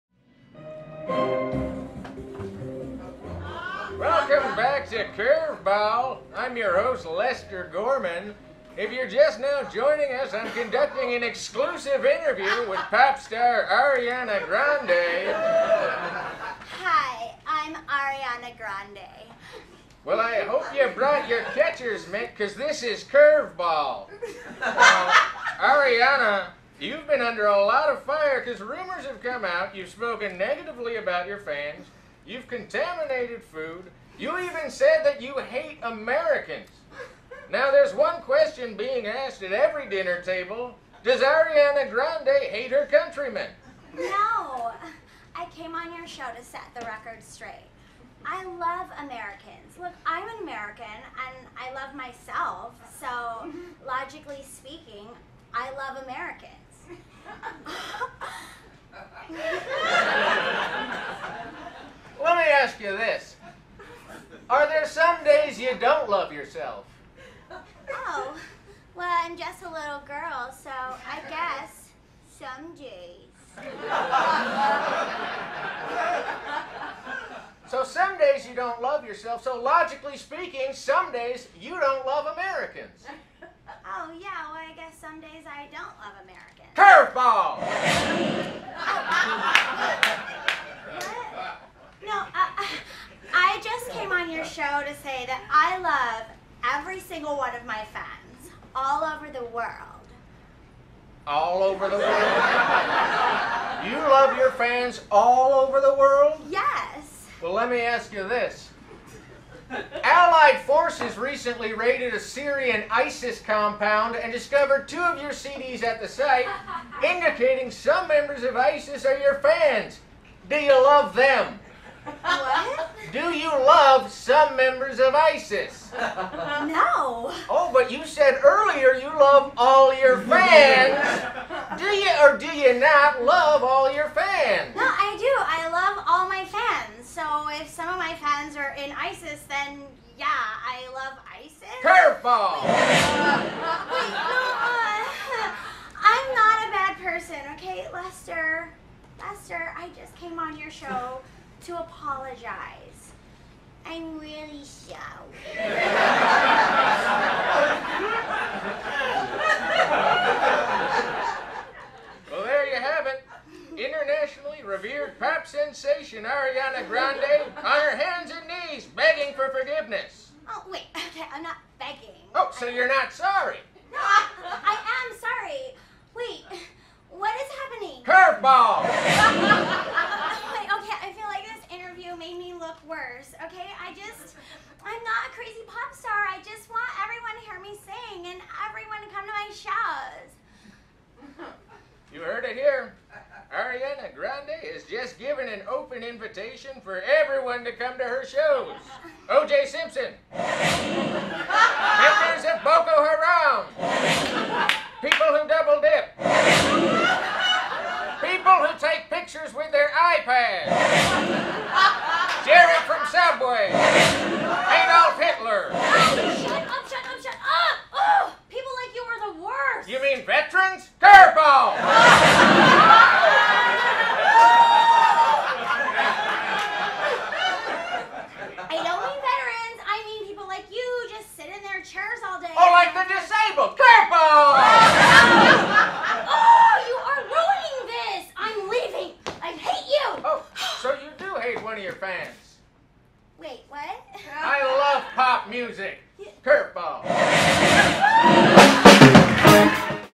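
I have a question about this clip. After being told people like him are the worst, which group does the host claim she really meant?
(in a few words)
veterans.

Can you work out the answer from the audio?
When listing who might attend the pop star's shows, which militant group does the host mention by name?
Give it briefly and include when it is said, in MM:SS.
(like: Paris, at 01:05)
Boko Haram, at 03:22.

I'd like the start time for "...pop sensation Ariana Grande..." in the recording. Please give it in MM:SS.
02:45.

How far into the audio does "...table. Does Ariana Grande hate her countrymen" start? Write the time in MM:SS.
00:40.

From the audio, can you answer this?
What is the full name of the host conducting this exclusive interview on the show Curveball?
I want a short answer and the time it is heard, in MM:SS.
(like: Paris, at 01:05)
Lester Gorman, at 00:07.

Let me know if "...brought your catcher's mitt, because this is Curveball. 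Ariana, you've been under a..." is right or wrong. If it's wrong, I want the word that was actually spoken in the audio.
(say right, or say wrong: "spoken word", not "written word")
right.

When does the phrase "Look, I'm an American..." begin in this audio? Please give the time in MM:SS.
00:49.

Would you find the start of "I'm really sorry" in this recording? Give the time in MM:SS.
02:33.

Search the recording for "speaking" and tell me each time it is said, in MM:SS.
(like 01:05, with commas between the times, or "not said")
00:54, 01:20.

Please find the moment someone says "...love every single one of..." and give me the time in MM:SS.
01:35.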